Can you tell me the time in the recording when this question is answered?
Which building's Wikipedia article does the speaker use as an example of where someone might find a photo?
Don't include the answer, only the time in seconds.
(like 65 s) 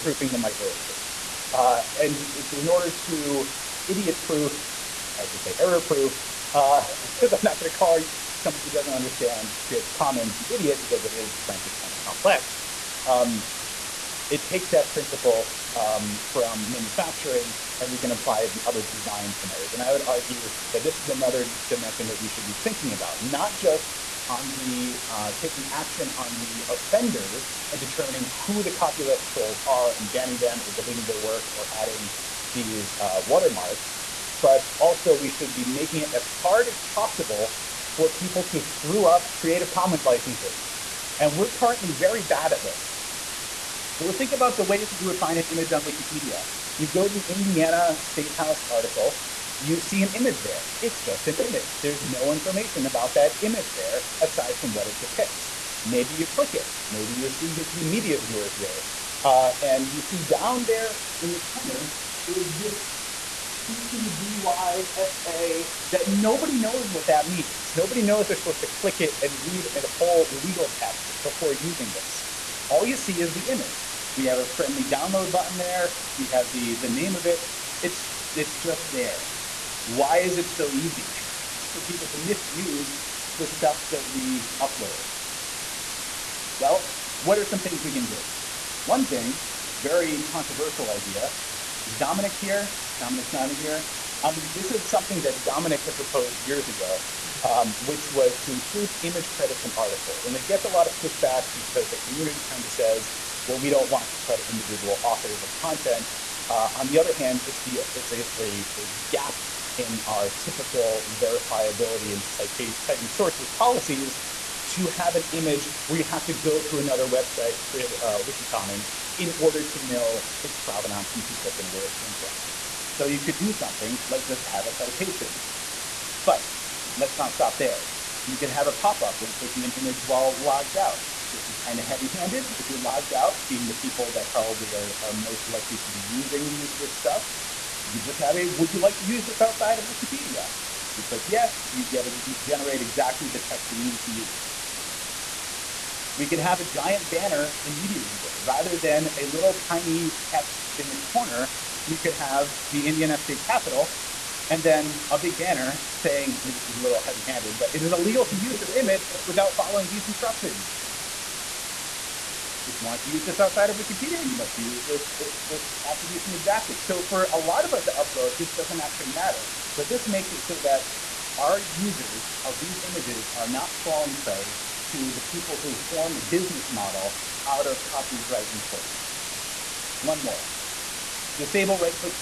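47 s.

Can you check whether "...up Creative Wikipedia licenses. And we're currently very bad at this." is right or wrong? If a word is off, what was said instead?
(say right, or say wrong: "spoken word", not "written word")
wrong: "Commons", not "Wikipedia".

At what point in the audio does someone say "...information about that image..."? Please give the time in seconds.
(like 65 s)
52 s.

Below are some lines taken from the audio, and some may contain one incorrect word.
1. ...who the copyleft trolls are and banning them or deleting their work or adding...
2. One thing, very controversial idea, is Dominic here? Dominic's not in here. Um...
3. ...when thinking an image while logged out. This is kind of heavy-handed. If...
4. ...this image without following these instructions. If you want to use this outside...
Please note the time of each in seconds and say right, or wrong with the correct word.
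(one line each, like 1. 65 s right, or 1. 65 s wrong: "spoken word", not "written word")
1. 28 s right
2. 88 s right
3. 129 s wrong: "clicking", not "thinking"
4. 158 s right.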